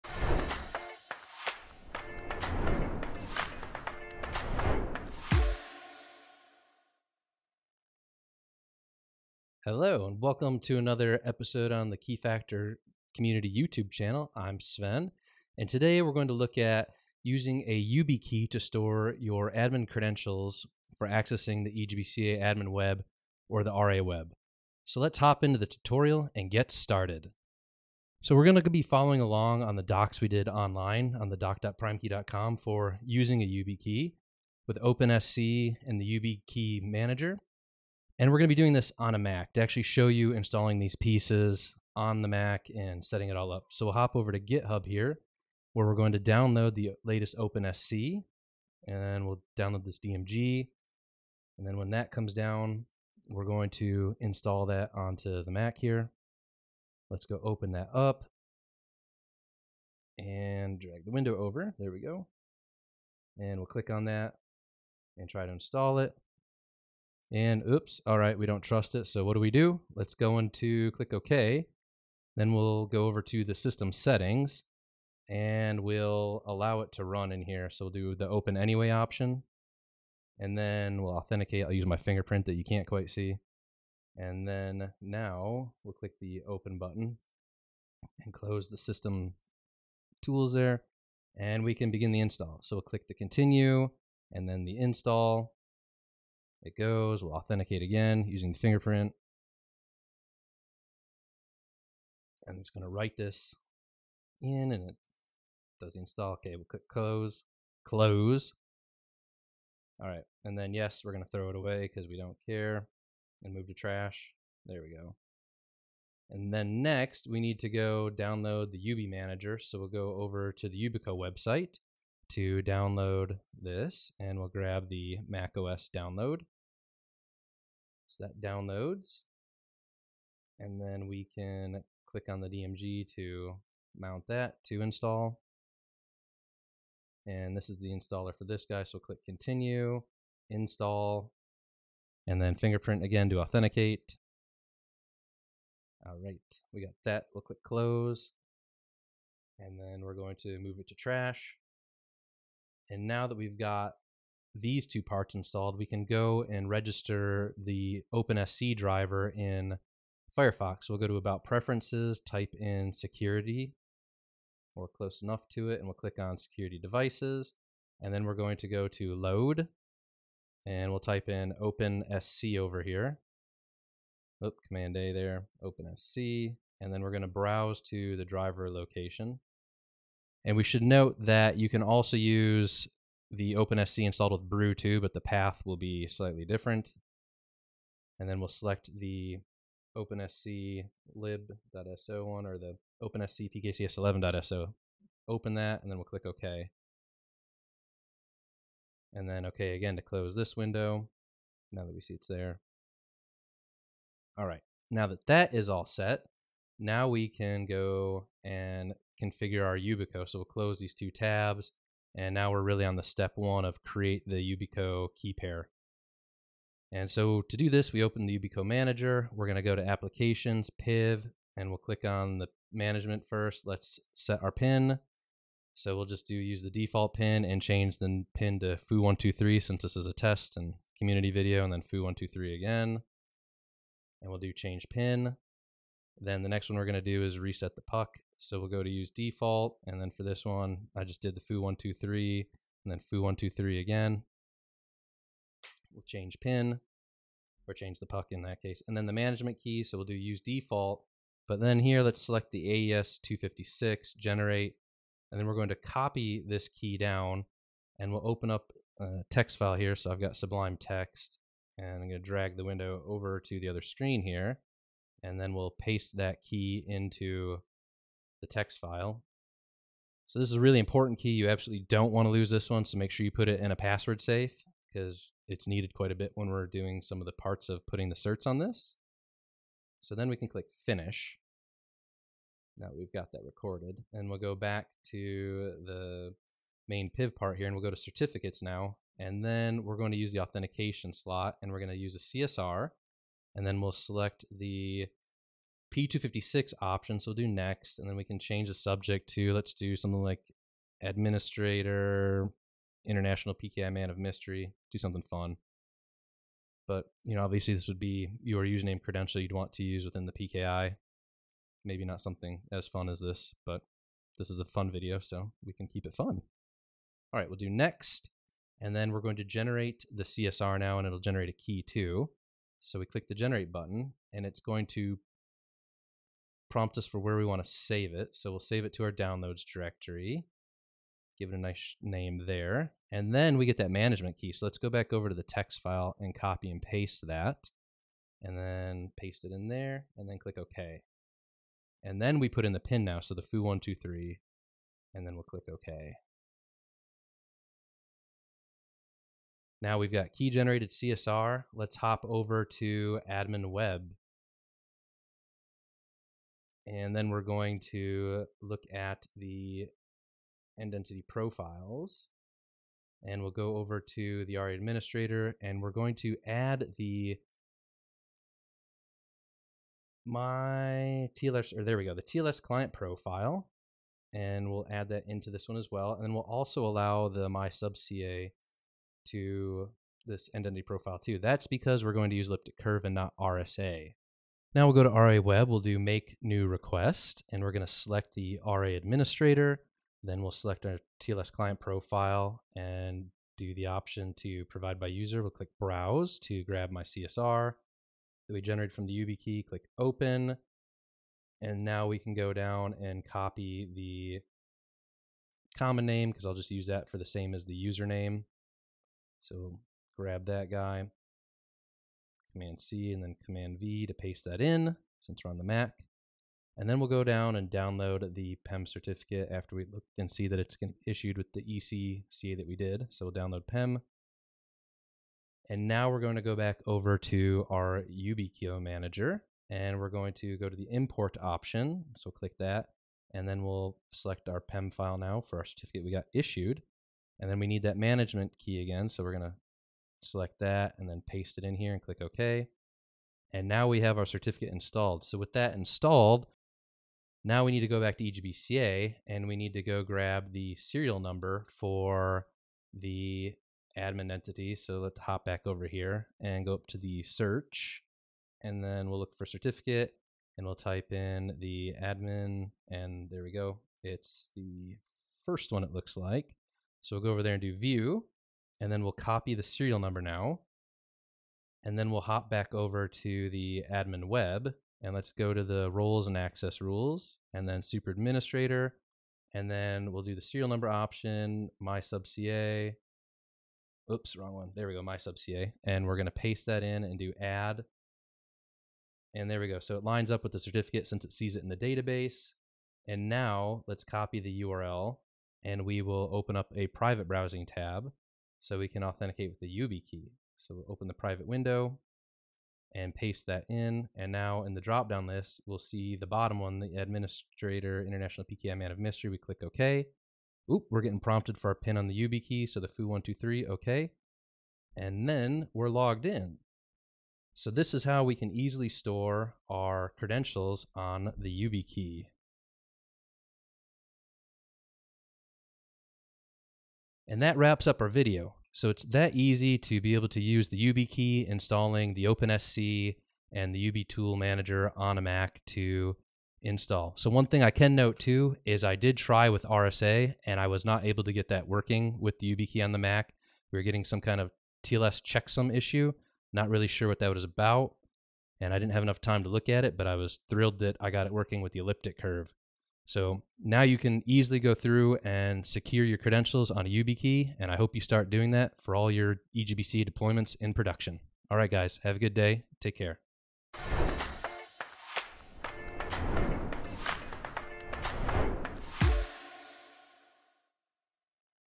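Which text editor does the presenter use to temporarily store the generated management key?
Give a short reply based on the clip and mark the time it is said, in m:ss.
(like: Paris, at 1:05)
Sublime Text, at 4:20.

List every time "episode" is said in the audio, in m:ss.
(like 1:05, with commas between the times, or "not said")
0:11.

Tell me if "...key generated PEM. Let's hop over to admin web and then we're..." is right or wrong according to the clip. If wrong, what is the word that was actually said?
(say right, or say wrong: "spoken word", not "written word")
wrong: "CSR", not "PEM".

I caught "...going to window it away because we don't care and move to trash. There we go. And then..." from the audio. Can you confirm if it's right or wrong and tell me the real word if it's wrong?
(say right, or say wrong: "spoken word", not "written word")
wrong: "throw", not "window".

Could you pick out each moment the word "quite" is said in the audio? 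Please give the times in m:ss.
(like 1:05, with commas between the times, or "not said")
1:22, 4:35.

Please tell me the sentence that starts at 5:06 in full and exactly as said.
But you know, obviously, this would be your username credential you'd want to use within the PKI.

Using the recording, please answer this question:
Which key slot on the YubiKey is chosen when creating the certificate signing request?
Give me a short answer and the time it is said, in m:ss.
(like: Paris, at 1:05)
authentication slot, at 4:50.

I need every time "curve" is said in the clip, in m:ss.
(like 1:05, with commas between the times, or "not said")
6:22, 9:12.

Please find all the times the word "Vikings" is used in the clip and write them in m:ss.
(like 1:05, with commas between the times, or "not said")
not said.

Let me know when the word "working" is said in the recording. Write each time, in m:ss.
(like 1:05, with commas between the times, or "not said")
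9:01, 9:11.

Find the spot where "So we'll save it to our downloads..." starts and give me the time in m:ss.
5:28.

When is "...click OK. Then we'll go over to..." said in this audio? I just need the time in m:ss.
1:10.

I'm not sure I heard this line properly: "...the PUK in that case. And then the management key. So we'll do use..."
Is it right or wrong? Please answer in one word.
right.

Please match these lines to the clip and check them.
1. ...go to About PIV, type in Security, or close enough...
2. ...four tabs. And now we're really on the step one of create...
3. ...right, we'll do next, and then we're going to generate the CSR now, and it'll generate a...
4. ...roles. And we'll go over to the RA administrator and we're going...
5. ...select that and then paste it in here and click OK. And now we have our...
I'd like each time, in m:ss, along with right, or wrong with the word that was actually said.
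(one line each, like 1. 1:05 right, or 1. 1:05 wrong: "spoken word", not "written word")
1. 2:40 wrong: "Preferences", not "PIV"
2. 3:30 wrong: "two", not "four"
3. 5:17 right
4. 6:01 wrong: "profiles", not "roles"
5. 7:20 right.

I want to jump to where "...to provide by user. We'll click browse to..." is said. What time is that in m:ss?
6:34.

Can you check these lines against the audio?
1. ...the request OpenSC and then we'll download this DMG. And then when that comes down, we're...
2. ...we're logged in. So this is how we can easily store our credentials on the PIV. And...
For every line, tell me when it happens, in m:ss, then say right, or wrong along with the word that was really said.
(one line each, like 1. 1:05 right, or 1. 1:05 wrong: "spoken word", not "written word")
1. 0:46 wrong: "latest", not "request"
2. 8:35 wrong: "YubiKey", not "PIV".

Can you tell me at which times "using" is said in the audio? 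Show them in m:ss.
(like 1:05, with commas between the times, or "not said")
0:17, 0:33, 1:38.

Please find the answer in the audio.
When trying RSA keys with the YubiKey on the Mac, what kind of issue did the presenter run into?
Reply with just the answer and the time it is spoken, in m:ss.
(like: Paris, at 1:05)
TLS checksum issue, at 9:04.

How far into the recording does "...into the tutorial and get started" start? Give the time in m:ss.
0:25.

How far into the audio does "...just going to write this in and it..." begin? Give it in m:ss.
1:42.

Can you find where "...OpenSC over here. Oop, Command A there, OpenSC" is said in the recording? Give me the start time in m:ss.
2:51.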